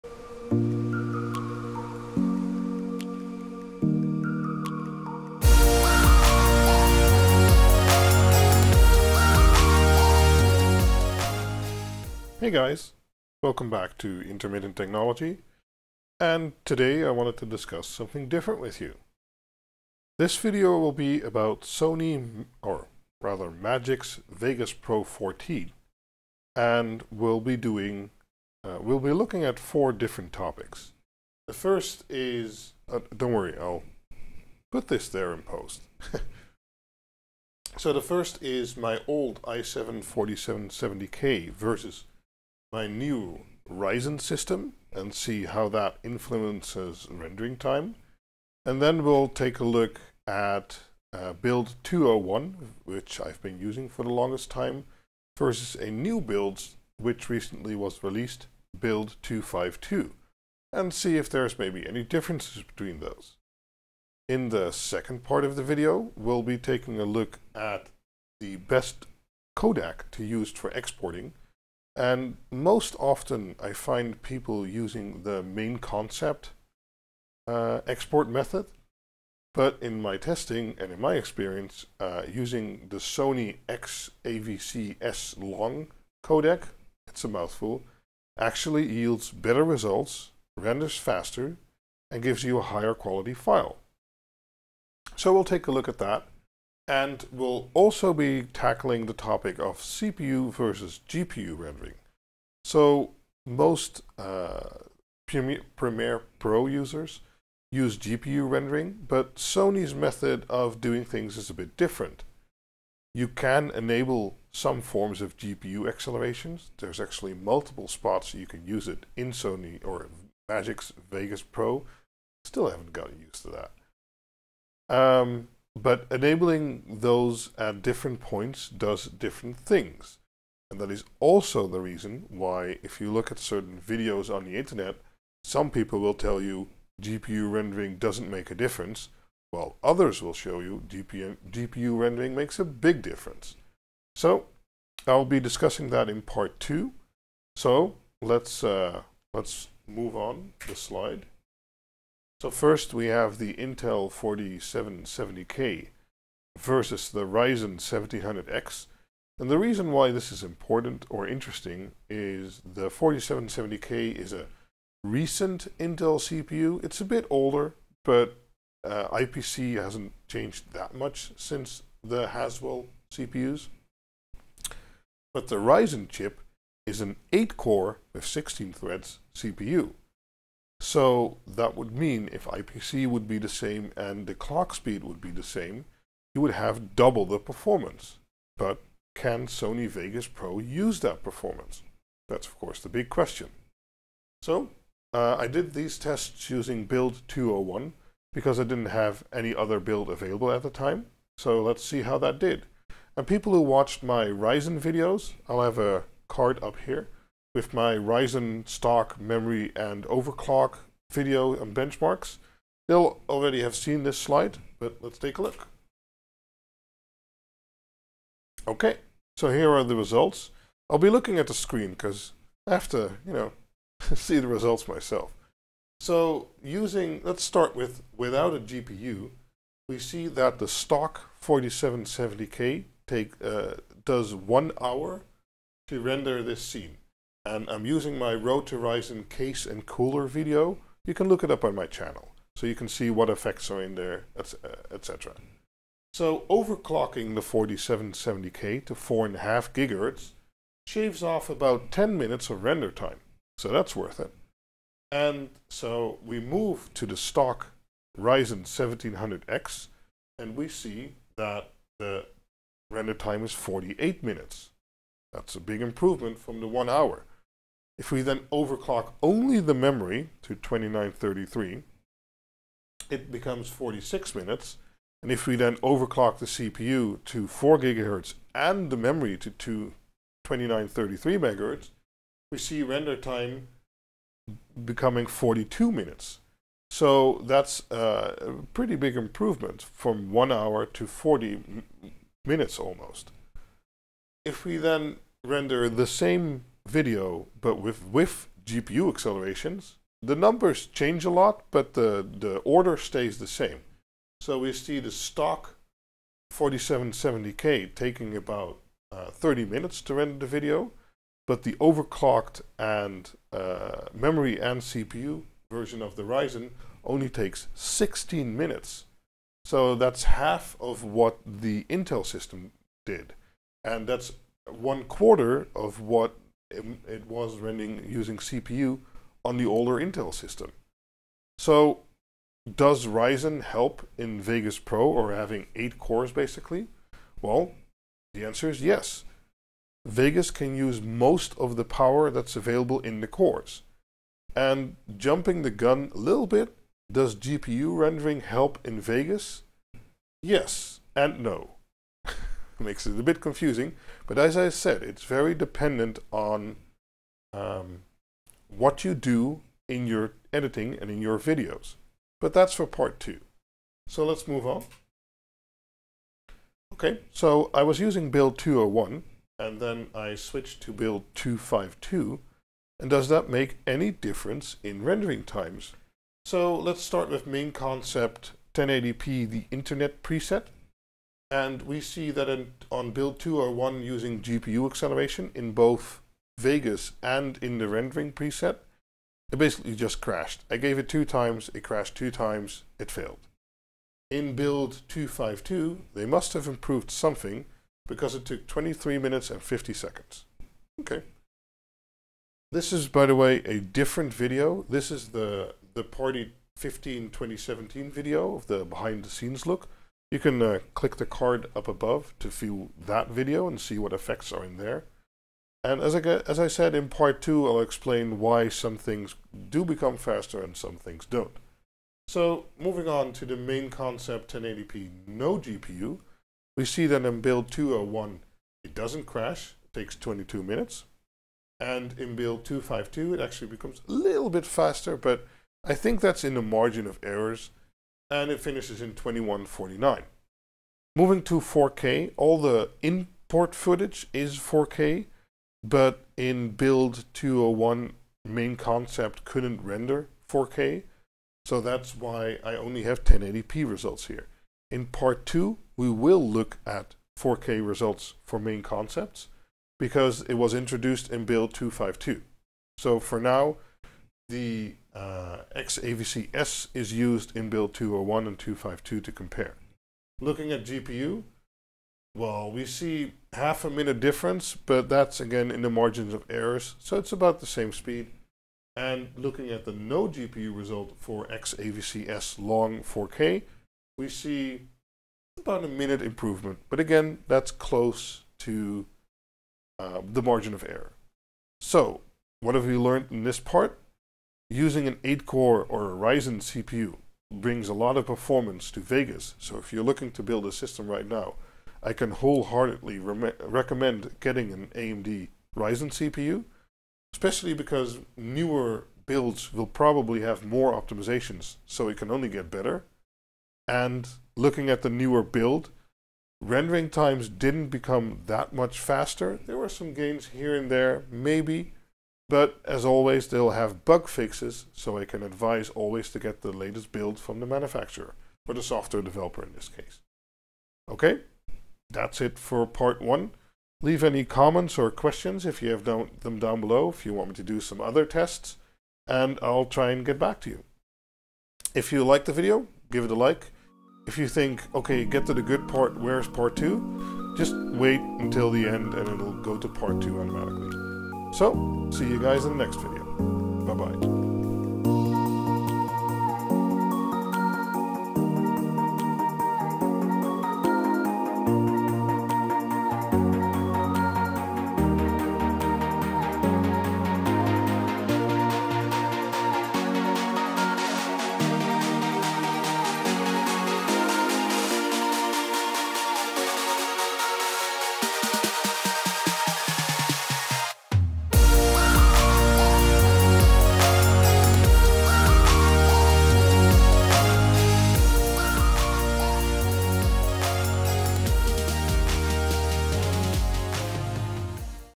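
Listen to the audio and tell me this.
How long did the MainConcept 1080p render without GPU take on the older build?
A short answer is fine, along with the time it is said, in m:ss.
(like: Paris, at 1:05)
22 minutes, at 7:10.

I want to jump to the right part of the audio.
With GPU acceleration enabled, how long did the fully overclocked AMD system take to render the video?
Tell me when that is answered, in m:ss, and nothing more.
5:17.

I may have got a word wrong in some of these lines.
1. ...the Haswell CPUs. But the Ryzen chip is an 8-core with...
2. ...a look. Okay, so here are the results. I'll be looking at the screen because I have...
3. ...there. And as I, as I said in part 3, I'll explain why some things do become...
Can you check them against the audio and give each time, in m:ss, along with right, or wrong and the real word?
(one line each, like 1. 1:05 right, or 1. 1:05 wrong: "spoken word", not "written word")
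1. 2:52 right
2. 3:35 right
3. 6:54 wrong: "2", not "3".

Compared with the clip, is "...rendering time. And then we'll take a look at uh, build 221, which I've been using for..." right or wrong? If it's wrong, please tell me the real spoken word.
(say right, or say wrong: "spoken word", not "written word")
wrong: "201", not "221".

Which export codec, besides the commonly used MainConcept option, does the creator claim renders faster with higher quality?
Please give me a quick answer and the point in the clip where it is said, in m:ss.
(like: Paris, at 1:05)
Sony XAVC-S long, at 1:22.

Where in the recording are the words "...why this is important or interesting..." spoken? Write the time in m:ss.
2:39.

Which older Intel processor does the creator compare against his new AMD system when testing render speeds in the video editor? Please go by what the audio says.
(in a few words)
i7 4770K.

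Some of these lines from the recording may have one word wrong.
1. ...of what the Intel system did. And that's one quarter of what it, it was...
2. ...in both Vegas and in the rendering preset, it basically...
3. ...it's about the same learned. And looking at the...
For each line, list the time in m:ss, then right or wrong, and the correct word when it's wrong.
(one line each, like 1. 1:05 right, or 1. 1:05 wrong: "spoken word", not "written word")
1. 5:20 right
2. 6:25 right
3. 7:57 wrong: "speed", not "learned".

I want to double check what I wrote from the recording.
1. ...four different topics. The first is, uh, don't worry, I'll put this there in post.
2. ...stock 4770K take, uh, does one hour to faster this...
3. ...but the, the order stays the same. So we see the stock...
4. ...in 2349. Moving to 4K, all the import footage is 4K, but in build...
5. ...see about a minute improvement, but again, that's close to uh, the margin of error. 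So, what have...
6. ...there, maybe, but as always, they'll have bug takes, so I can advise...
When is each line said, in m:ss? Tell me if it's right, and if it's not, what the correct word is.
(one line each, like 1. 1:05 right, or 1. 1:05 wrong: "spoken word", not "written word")
1. 0:29 right
2. 3:50 wrong: "render", not "faster"
3. 5:01 right
4. 7:19 wrong: "2149", not "2349"
5. 8:04 right
6. 8:40 wrong: "fixes", not "takes".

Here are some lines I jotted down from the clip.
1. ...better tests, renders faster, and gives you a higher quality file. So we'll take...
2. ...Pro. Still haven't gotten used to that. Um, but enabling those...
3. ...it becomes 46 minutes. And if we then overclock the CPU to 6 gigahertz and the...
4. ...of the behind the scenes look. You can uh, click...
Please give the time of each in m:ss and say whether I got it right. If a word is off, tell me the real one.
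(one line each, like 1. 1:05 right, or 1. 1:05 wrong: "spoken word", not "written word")
1. 1:29 wrong: "results", not "tests"
2. 2:01 right
3. 4:33 wrong: "4", not "6"
4. 6:48 right.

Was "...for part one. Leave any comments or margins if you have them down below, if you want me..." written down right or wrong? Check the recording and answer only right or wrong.
wrong.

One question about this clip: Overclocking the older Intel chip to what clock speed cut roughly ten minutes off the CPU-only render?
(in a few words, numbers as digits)
4.5 gigahertz.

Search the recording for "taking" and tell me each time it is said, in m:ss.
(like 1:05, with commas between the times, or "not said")
1:06, 5:07.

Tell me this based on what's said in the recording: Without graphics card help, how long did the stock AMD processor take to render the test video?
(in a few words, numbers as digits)
48 minutes.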